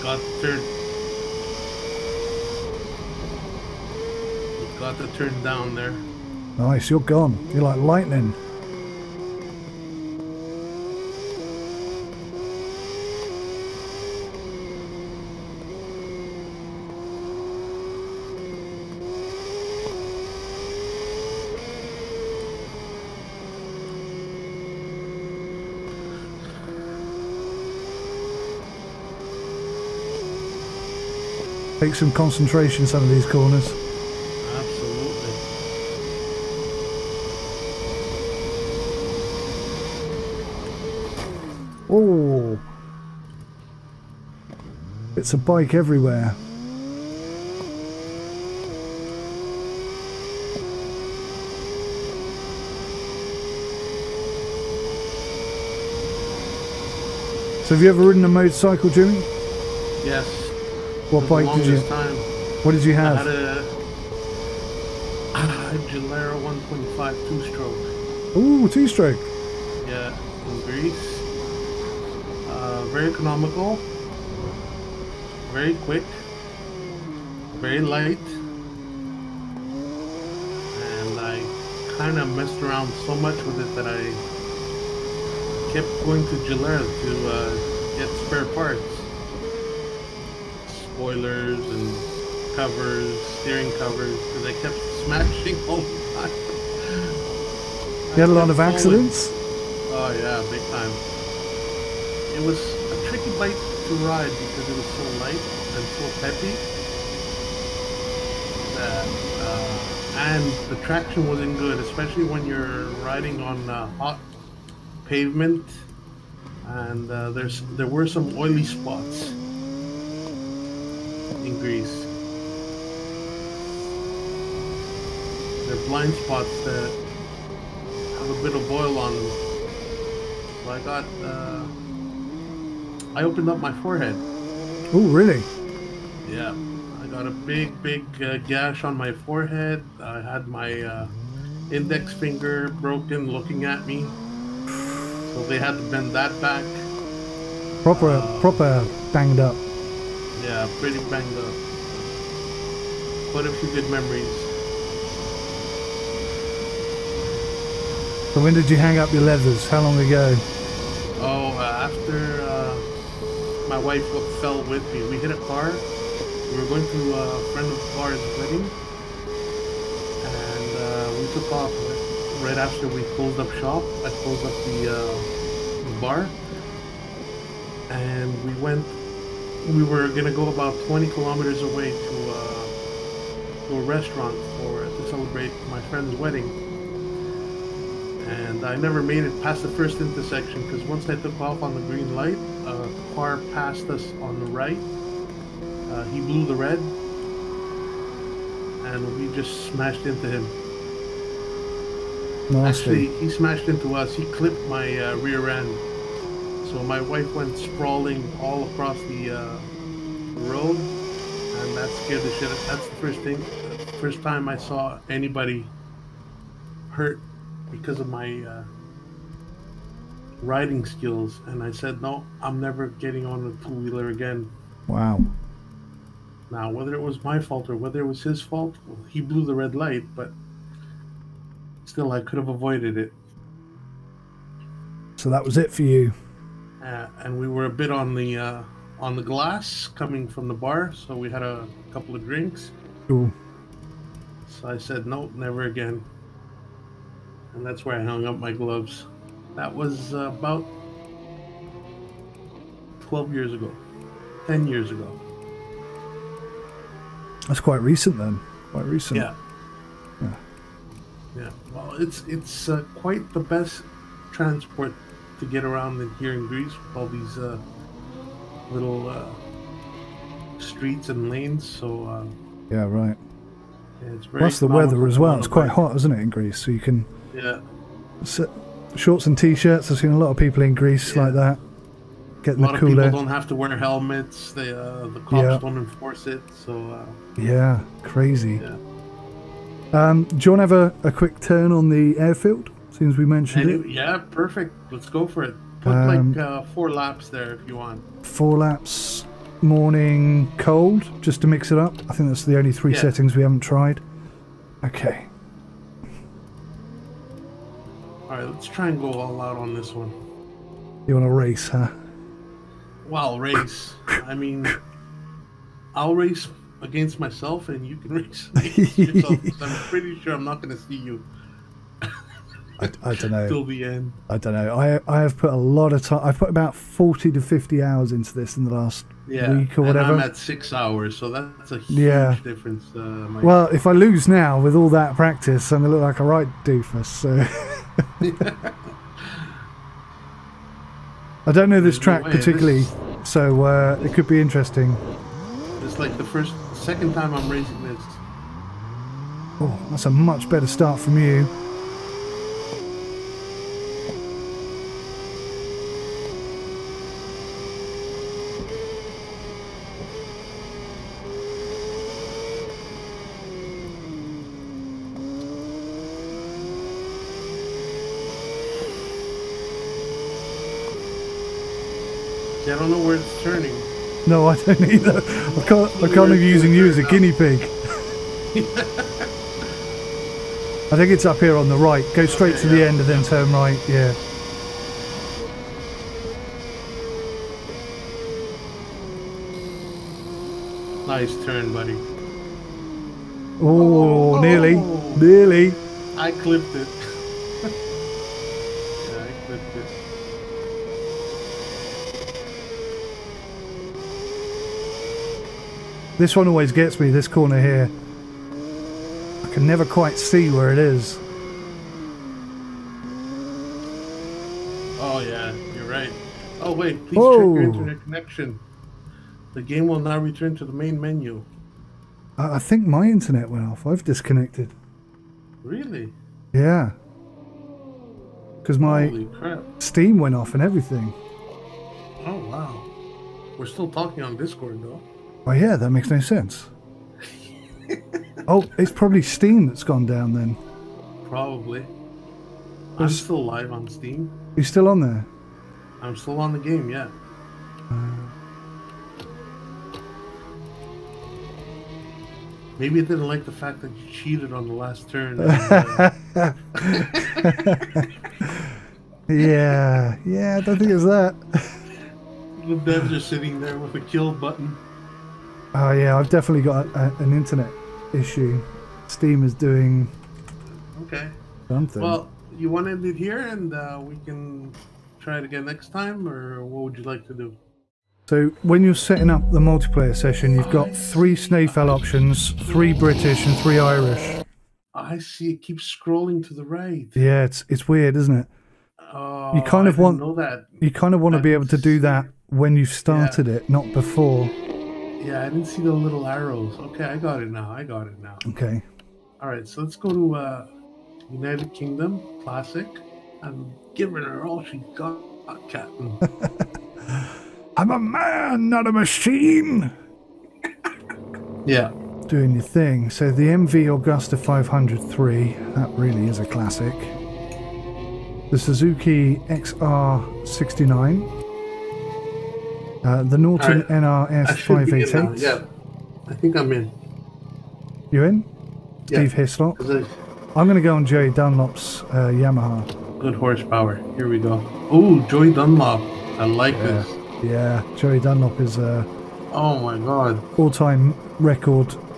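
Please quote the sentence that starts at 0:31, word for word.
Take some concentration, some of these corners.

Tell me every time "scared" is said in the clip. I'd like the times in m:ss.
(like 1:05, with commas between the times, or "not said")
3:32.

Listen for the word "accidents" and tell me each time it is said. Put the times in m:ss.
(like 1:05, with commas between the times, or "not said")
1:38.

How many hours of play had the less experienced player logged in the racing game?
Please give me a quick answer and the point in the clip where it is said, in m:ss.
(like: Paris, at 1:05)
6, at 5:30.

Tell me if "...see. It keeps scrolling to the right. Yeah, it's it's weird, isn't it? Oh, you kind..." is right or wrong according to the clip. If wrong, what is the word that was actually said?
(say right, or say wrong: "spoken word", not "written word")
right.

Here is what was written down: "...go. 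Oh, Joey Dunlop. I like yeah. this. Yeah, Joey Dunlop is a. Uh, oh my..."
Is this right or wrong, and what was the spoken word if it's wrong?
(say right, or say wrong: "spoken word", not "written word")
right.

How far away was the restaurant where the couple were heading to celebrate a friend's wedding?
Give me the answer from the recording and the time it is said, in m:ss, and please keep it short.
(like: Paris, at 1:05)
20 kilometers, at 3:00.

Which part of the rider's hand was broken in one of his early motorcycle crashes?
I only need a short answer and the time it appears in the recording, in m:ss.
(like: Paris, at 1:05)
Index finger, at 2:21.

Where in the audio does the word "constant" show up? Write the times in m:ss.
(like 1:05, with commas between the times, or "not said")
not said.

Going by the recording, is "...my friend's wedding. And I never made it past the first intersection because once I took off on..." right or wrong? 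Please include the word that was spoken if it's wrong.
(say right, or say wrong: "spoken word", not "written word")
right.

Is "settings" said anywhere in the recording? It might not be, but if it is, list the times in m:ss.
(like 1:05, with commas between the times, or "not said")
5:03, 7:58.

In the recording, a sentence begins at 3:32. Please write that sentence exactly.
That's the first thing, first time I saw anybody hurt because of my uh, riding skills.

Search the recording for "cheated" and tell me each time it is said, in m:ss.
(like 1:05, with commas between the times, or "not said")
7:34.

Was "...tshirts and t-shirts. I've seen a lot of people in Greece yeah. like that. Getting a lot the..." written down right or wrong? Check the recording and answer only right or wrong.
wrong.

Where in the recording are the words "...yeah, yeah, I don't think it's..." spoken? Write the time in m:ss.
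7:39.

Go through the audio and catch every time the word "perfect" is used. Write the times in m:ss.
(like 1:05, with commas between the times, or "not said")
4:54.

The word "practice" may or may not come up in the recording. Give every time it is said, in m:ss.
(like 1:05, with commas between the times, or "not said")
5:35.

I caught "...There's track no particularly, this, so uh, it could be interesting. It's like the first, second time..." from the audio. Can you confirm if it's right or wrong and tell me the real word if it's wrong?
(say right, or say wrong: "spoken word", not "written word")
right.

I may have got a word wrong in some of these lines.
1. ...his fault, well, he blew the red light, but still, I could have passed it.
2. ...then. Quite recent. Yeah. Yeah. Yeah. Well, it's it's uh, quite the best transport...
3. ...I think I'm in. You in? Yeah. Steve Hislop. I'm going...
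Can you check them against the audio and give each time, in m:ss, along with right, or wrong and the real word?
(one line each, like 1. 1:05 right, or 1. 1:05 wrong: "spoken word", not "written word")
1. 3:48 wrong: "avoided", not "passed"
2. 4:18 right
3. 8:46 right.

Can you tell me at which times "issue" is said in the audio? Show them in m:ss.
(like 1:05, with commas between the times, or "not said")
7:48.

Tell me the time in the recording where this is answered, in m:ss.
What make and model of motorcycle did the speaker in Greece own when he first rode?
1:05.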